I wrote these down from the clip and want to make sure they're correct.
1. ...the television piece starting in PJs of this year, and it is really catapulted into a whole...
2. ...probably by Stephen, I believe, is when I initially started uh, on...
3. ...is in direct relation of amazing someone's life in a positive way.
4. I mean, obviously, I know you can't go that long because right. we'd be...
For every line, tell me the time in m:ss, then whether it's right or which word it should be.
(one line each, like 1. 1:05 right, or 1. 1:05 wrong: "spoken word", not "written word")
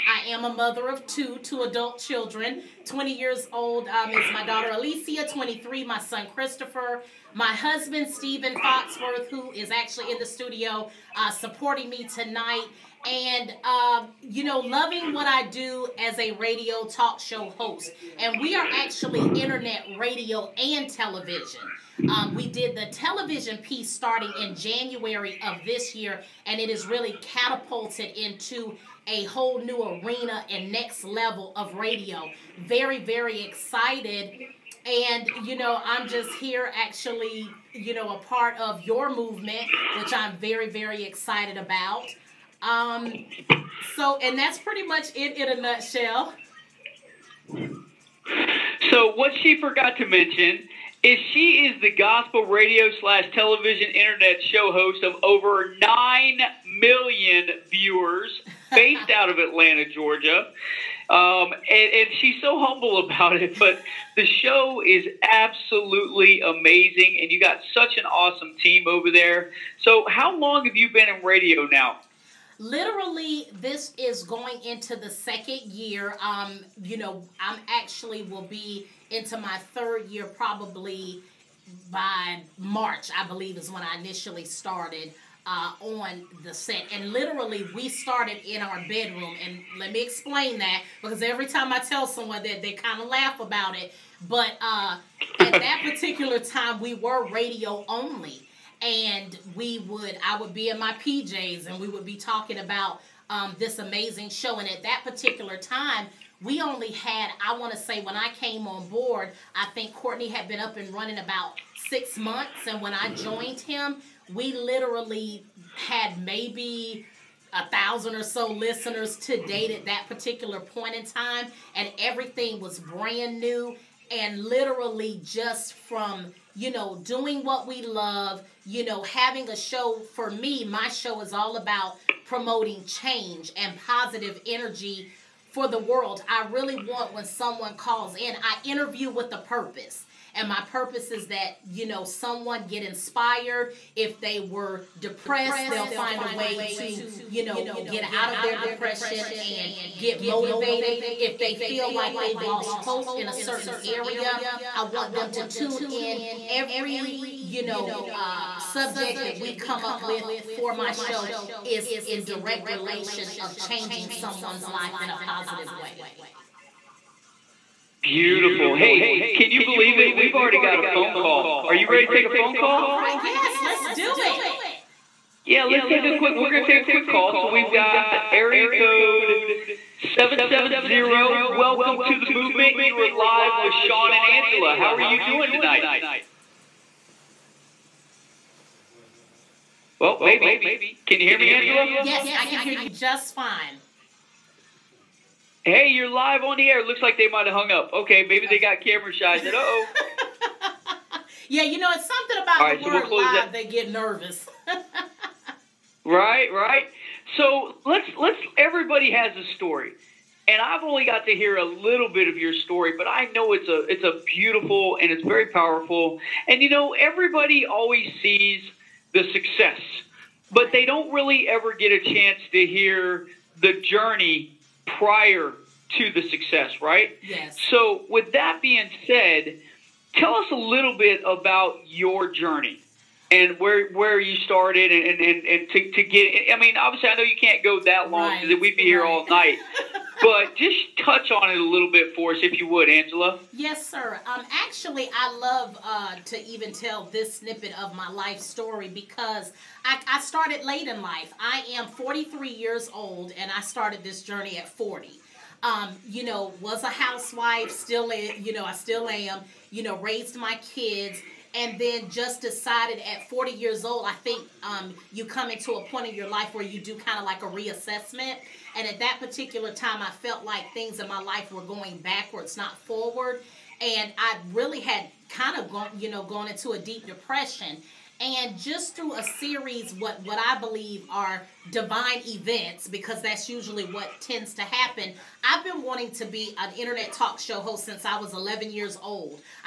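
1. 0:22 wrong: "January", not "PJs"
2. 1:20 wrong: "March", not "Stephen"
3. 2:41 wrong: "changing", not "amazing"
4. 3:56 right.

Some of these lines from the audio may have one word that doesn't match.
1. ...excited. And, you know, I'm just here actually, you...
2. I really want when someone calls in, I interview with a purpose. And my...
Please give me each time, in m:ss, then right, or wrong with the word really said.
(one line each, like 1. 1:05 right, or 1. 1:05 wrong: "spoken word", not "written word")
1. 0:33 right
2. 2:16 right.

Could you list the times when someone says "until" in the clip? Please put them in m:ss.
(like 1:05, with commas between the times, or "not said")
not said.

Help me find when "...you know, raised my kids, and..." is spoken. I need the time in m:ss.
4:19.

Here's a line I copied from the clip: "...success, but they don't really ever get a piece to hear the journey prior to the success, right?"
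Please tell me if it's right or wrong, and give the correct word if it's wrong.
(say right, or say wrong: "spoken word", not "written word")
wrong: "chance", not "piece".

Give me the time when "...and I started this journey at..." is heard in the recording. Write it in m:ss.
4:13.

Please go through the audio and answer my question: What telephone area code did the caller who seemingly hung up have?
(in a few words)
770.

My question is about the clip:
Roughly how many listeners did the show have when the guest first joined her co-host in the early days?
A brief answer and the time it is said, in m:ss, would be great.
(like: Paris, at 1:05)
1,000, at 1:57.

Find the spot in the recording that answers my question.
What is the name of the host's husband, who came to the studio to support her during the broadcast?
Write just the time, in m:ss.
0:08.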